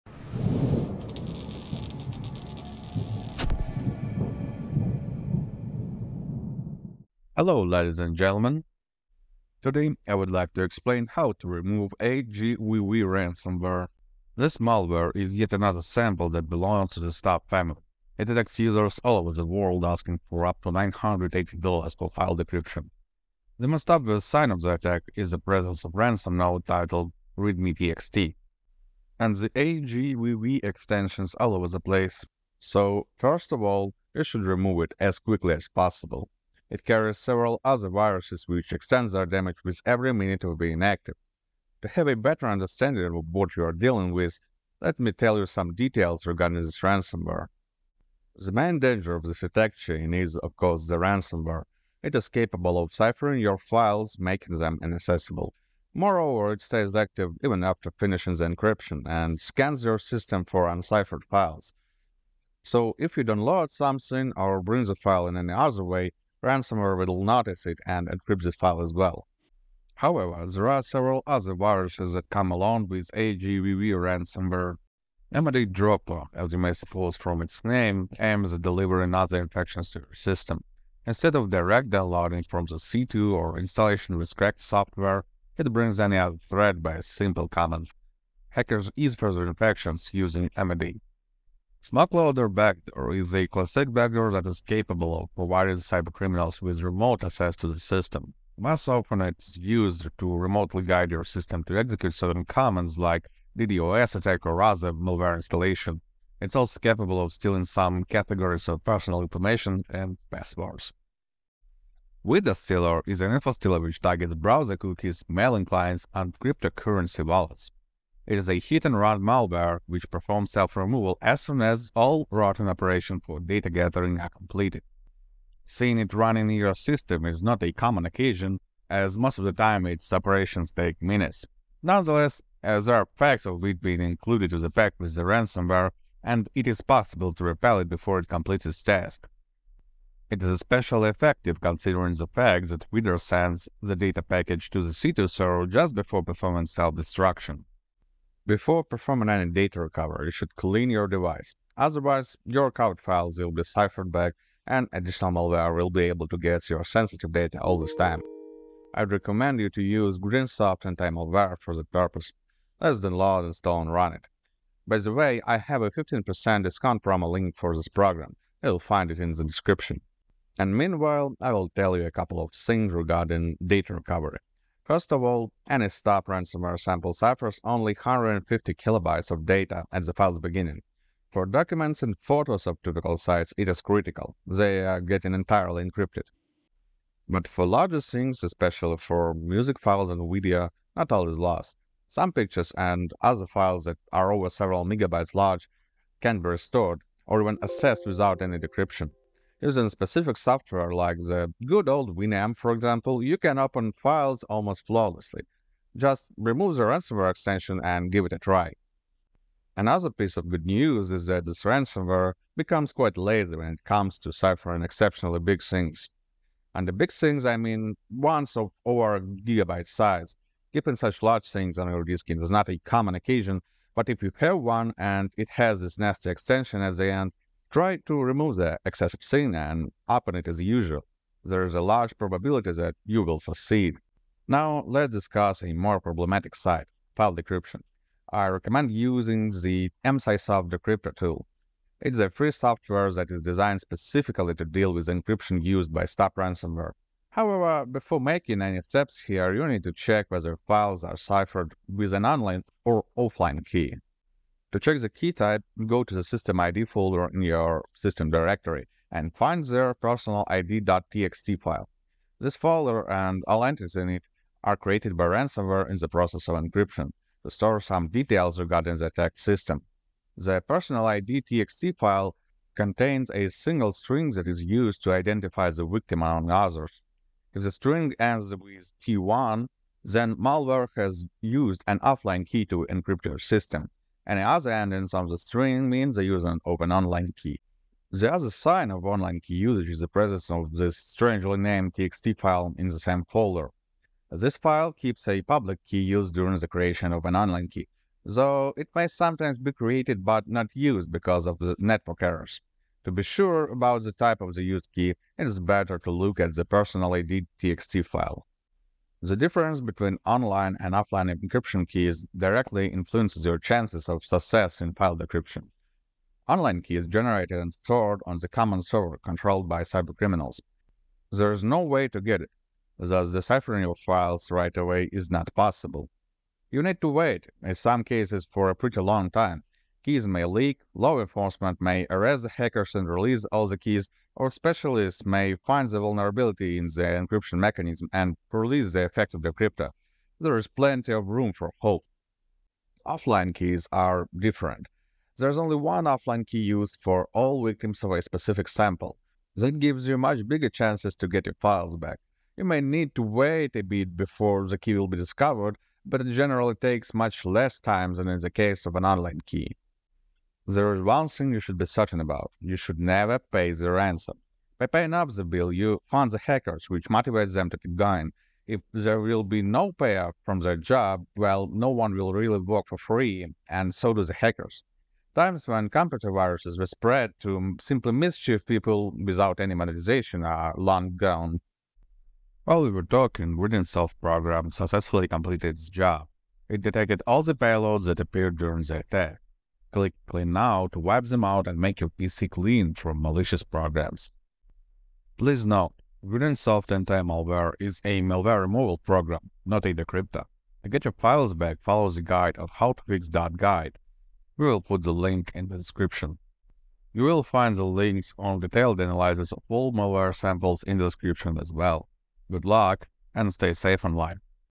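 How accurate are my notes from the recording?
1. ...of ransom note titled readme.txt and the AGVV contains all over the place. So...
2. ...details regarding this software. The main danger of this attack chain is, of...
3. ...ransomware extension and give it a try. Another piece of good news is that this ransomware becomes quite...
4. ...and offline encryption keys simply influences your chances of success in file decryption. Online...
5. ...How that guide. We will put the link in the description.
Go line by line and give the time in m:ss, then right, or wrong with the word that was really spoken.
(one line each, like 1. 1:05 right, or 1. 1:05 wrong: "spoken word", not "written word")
1. 0:25 wrong: "extensions", not "contains"
2. 0:45 wrong: "ransomware", not "software"
3. 3:26 right
4. 5:10 wrong: "directly", not "simply"
5. 6:42 right.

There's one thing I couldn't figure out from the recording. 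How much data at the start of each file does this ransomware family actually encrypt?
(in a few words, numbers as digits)
150 kilobytes.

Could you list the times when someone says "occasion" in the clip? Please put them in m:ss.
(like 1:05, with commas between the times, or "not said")
2:08, 3:43.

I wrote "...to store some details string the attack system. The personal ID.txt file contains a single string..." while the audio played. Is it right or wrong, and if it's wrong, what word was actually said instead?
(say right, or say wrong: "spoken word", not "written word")
wrong: "regarding", not "string".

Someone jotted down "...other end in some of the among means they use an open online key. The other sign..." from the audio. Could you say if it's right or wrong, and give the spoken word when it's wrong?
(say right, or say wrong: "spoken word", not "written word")
wrong: "string", not "among".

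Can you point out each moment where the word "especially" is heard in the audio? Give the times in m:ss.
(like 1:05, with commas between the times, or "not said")
2:20, 3:08.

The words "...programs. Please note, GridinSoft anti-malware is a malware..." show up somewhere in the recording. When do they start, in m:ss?
6:33.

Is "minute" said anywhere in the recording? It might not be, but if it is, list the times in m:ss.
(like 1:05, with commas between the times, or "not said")
0:40, 2:11.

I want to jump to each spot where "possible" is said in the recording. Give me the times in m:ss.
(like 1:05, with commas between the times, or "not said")
0:35, 2:16, 5:25.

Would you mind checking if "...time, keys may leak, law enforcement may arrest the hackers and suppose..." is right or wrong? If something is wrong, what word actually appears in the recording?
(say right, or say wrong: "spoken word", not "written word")
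wrong: "release", not "suppose".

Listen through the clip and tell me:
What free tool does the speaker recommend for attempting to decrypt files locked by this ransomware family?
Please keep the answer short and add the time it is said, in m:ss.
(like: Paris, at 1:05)
Emsisoft Decryptor, at 4:00.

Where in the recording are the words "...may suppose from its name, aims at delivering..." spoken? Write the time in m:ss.
1:16.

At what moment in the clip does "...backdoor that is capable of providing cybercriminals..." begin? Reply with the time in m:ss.
1:33.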